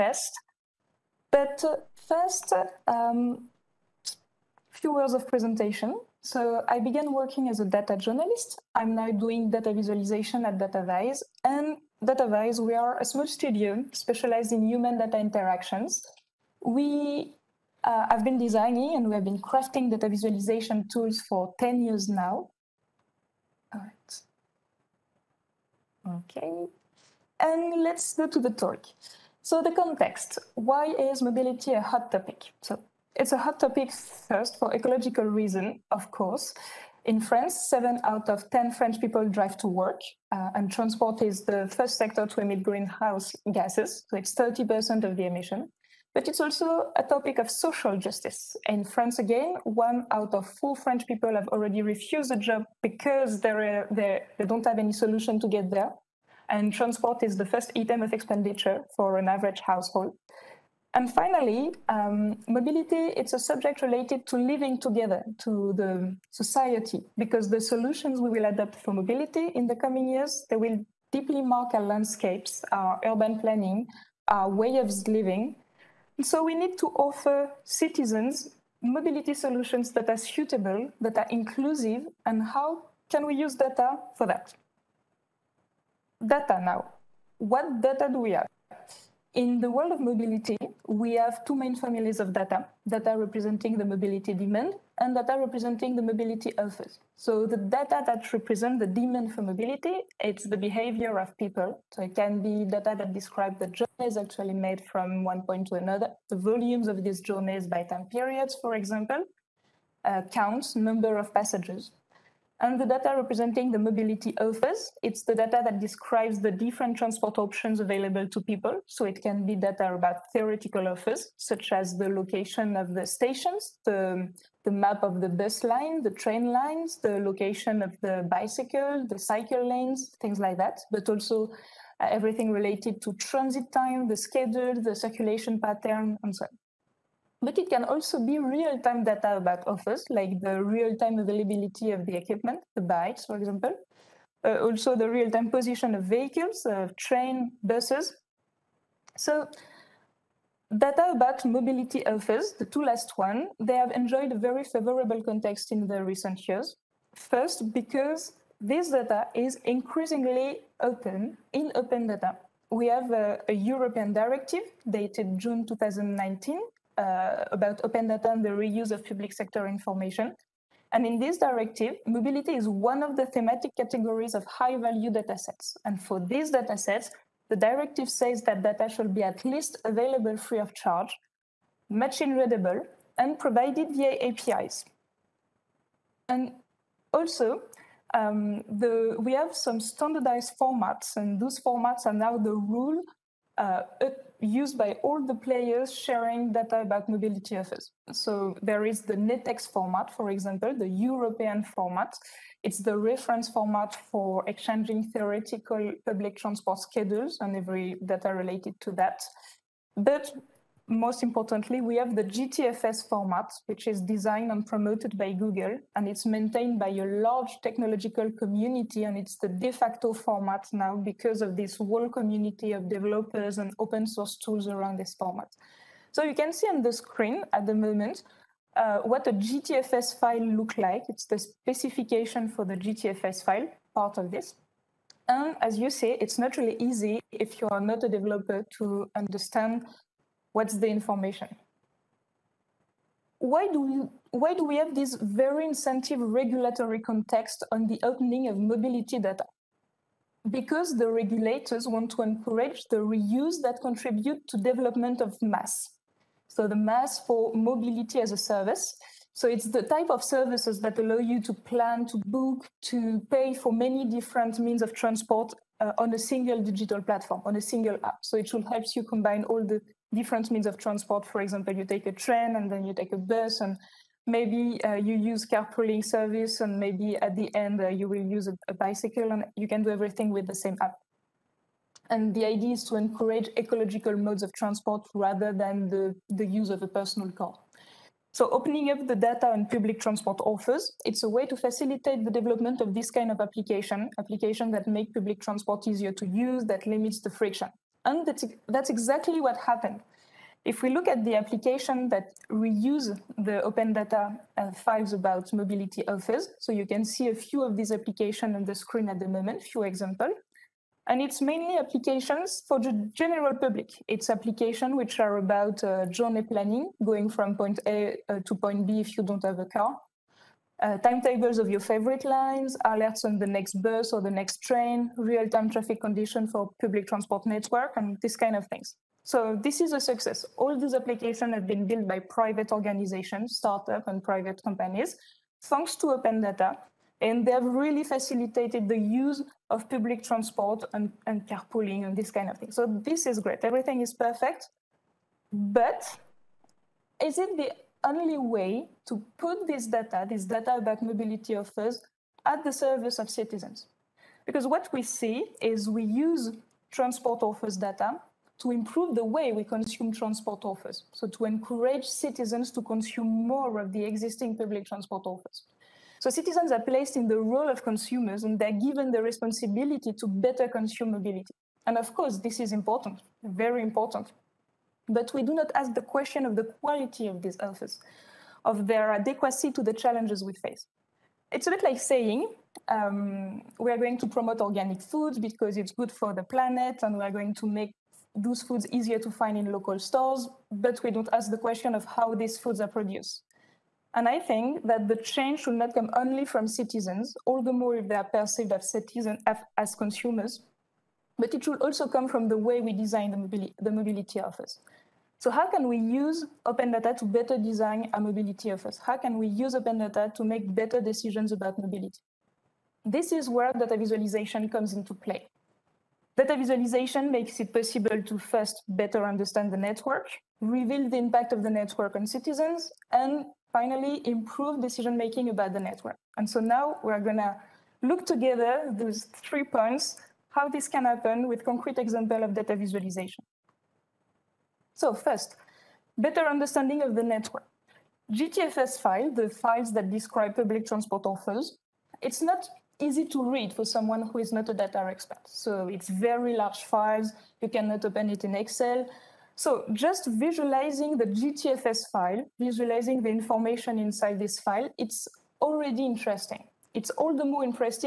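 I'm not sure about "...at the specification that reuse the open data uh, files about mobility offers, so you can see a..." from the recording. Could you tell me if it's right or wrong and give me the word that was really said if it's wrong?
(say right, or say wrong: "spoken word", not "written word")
wrong: "application", not "specification".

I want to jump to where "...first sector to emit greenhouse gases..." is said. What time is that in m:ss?
0:41.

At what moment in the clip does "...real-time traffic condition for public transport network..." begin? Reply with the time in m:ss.
5:25.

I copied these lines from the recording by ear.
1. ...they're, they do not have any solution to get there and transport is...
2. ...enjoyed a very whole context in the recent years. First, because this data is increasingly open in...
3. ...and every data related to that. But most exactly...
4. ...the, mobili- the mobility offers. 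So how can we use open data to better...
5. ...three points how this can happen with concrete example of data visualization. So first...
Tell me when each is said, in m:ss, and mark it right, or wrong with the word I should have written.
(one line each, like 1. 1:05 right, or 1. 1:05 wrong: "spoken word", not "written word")
1. 0:53 right
2. 2:33 wrong: "favorable", not "whole"
3. 3:27 wrong: "importantly", not "exactly"
4. 6:43 right
5. 7:09 right.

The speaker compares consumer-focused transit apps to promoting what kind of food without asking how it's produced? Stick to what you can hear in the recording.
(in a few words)
Organic foods.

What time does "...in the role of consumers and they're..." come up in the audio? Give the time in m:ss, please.
6:07.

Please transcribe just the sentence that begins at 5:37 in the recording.
And they've really facilitated the use of public transport and, and carpooling and this kind of thing.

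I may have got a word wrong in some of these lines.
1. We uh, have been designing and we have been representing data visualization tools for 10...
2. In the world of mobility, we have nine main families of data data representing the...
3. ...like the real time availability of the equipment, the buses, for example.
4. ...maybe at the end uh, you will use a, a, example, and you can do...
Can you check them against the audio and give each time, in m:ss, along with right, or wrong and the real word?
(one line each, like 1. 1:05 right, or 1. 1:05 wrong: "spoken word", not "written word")
1. 0:16 wrong: "crafting", not "representing"
2. 1:29 wrong: "two", not "nine"
3. 2:20 wrong: "bikes", not "buses"
4. 4:36 wrong: "bicycle", not "example".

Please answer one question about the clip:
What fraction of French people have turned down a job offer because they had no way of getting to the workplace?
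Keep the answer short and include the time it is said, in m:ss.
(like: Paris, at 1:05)
1 out of 4, at 0:49.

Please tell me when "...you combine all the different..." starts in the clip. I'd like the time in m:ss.
4:28.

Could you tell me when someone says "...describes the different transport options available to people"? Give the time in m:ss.
1:55.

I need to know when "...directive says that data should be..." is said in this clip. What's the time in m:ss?
2:57.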